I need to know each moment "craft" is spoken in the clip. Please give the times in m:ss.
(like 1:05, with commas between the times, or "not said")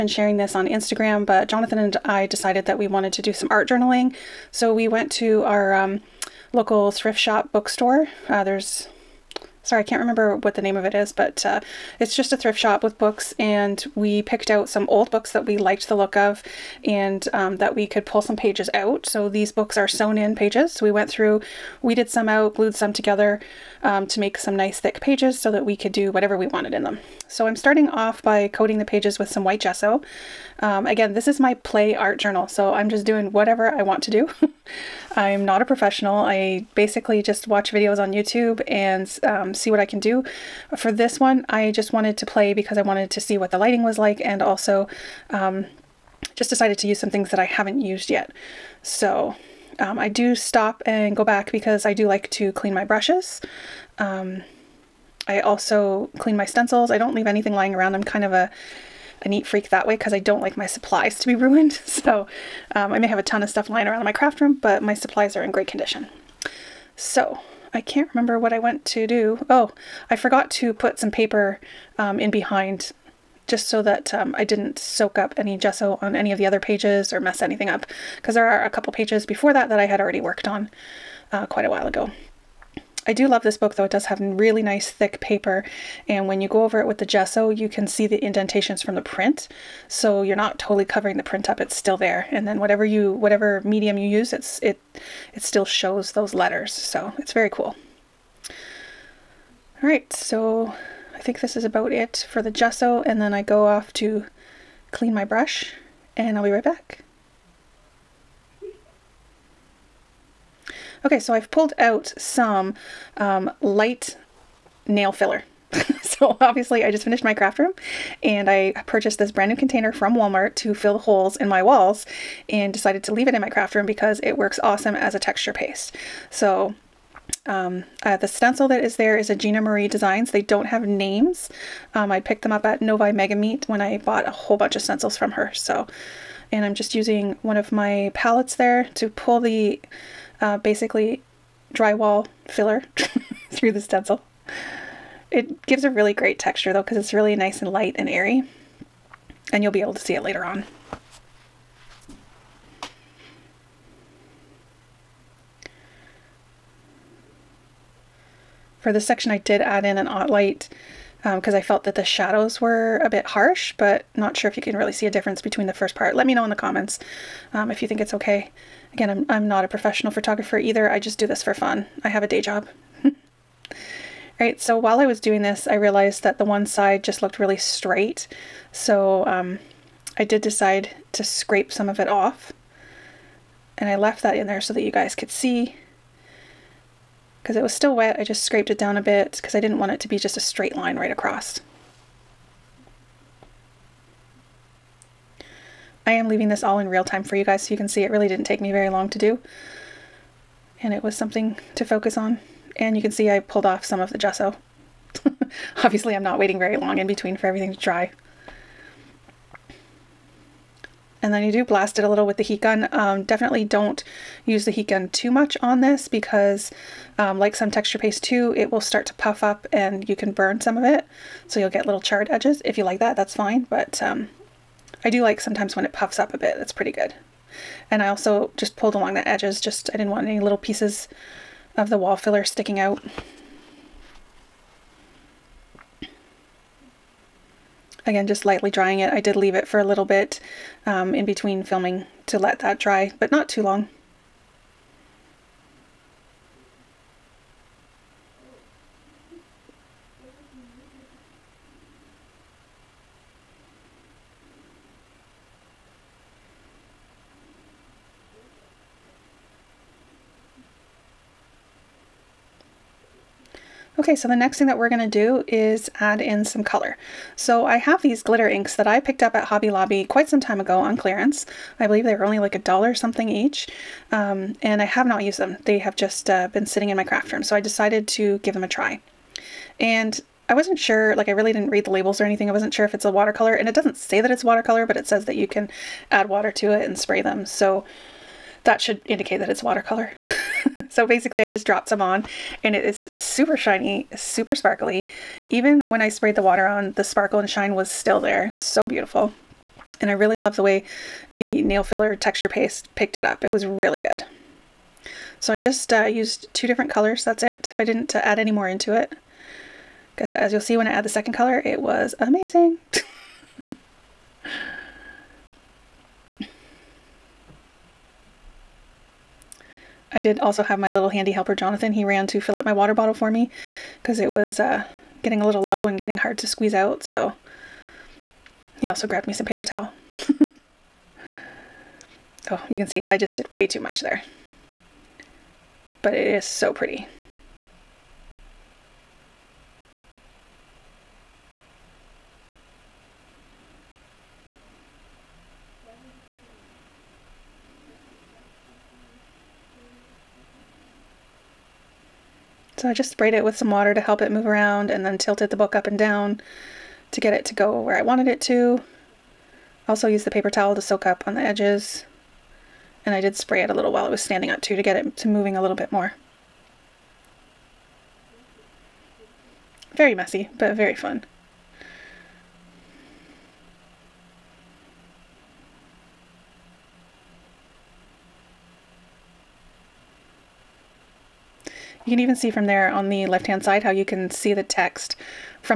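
1:04, 1:57, 2:03, 4:37.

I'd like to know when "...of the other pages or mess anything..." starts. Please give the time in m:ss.
1:16.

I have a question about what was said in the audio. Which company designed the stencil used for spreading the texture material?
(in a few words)
Gina Marie Designs.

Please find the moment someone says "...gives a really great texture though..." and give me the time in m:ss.
2:25.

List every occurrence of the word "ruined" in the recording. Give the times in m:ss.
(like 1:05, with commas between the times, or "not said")
1:01.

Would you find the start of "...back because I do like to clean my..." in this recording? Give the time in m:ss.
0:51.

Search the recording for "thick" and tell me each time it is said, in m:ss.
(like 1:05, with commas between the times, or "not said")
0:24, 1:24.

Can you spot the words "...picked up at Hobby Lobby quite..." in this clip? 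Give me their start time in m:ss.
4:28.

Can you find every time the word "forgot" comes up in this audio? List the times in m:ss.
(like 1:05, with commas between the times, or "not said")
1:10.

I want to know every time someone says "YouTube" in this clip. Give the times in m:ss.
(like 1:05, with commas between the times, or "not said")
0:38.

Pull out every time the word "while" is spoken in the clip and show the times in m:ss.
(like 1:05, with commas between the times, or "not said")
1:21, 2:54, 6:03.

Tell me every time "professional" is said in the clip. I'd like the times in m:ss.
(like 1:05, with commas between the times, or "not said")
0:35, 2:49.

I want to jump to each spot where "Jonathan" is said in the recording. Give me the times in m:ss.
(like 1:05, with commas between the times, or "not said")
0:01, 5:21.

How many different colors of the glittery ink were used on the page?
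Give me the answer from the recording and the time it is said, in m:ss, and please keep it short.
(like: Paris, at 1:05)
2, at 5:06.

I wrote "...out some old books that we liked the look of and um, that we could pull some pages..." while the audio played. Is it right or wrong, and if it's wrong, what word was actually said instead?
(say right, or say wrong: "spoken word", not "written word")
right.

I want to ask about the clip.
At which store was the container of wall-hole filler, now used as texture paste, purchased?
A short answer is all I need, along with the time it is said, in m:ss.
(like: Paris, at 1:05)
Walmart, at 2:00.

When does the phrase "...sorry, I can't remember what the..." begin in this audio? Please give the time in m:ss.
0:09.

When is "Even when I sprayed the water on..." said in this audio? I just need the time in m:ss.
4:55.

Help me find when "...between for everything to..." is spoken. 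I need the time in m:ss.
3:27.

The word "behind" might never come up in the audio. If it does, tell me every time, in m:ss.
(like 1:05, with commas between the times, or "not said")
1:12.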